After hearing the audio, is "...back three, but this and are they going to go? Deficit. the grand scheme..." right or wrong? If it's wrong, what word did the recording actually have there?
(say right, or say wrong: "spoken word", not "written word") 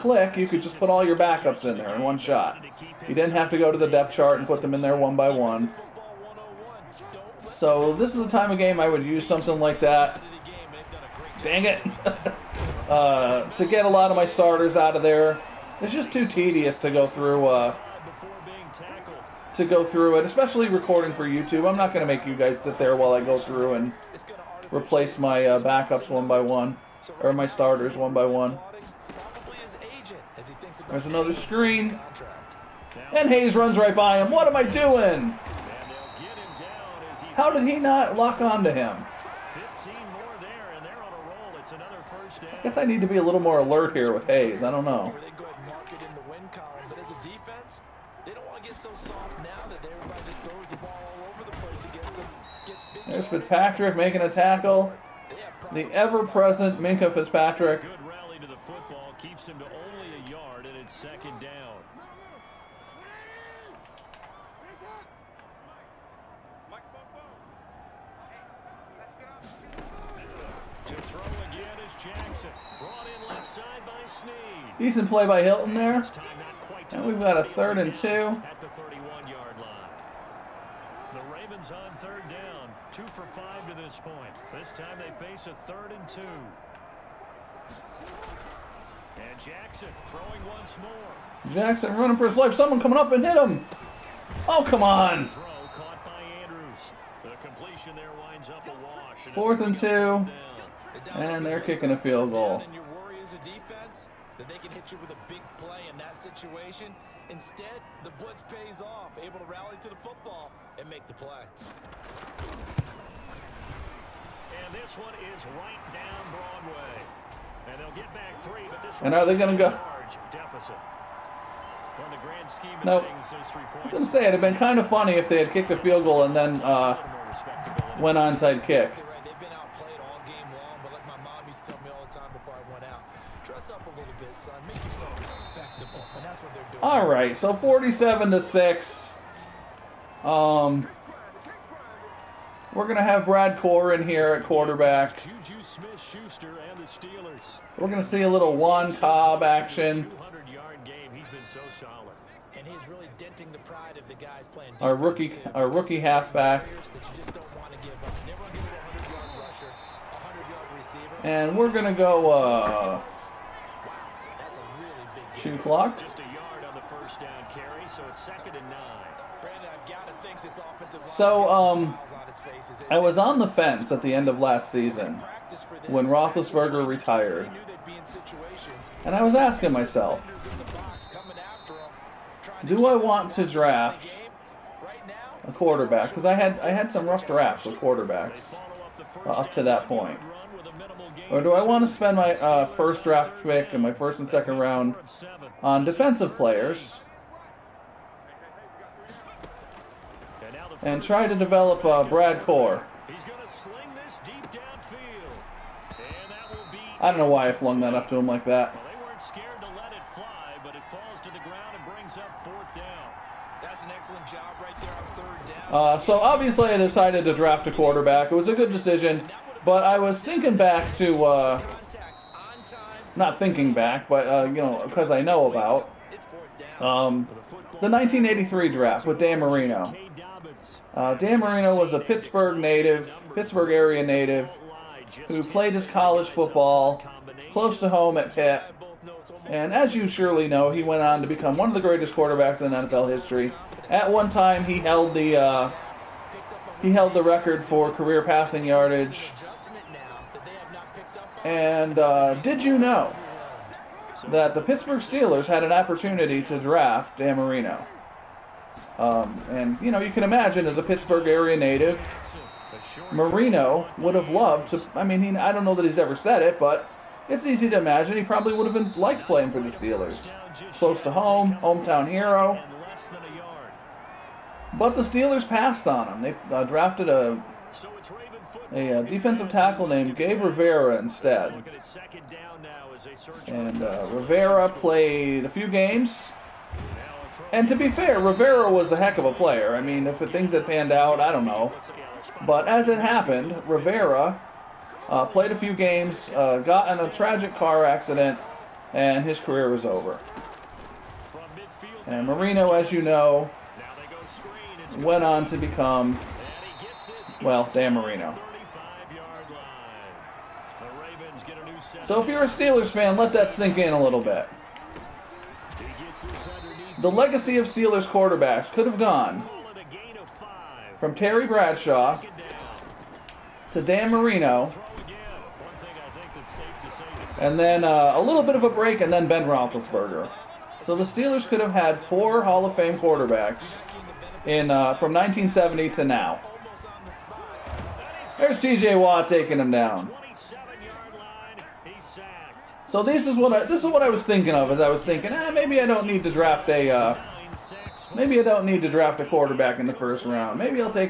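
right.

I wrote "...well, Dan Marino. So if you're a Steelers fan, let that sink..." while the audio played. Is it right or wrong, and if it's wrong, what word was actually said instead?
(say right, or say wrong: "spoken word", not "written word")
right.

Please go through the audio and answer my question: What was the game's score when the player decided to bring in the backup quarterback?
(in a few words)
47 to 6.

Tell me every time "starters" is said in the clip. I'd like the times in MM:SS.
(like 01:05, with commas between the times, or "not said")
00:14, 00:27.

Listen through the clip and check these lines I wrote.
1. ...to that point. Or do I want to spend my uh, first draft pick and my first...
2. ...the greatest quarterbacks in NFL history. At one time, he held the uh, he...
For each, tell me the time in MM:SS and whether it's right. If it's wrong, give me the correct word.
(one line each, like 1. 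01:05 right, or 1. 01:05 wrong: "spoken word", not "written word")
1. 03:09 right
2. 04:01 right.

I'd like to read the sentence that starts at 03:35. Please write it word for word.
Uh, so obviously I decided to draft a quarterback.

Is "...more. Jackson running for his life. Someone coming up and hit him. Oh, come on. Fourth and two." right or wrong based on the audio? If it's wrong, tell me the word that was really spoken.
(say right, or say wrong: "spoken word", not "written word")
right.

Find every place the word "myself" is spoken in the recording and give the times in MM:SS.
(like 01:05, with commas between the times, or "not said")
02:59.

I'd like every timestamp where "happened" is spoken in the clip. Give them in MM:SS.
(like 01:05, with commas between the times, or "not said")
04:52.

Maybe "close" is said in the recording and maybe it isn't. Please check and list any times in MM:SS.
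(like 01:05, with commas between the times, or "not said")
03:57, 04:30.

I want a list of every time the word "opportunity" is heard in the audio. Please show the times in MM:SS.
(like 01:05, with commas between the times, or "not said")
04:15.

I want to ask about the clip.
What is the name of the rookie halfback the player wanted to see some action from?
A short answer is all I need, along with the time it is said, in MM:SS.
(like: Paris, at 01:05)
Juan Cobb, at 02:28.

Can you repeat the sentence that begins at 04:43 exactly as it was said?
And uh, Rivera played a few games.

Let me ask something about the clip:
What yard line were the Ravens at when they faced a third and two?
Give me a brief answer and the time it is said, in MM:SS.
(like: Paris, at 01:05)
31, at 01:18.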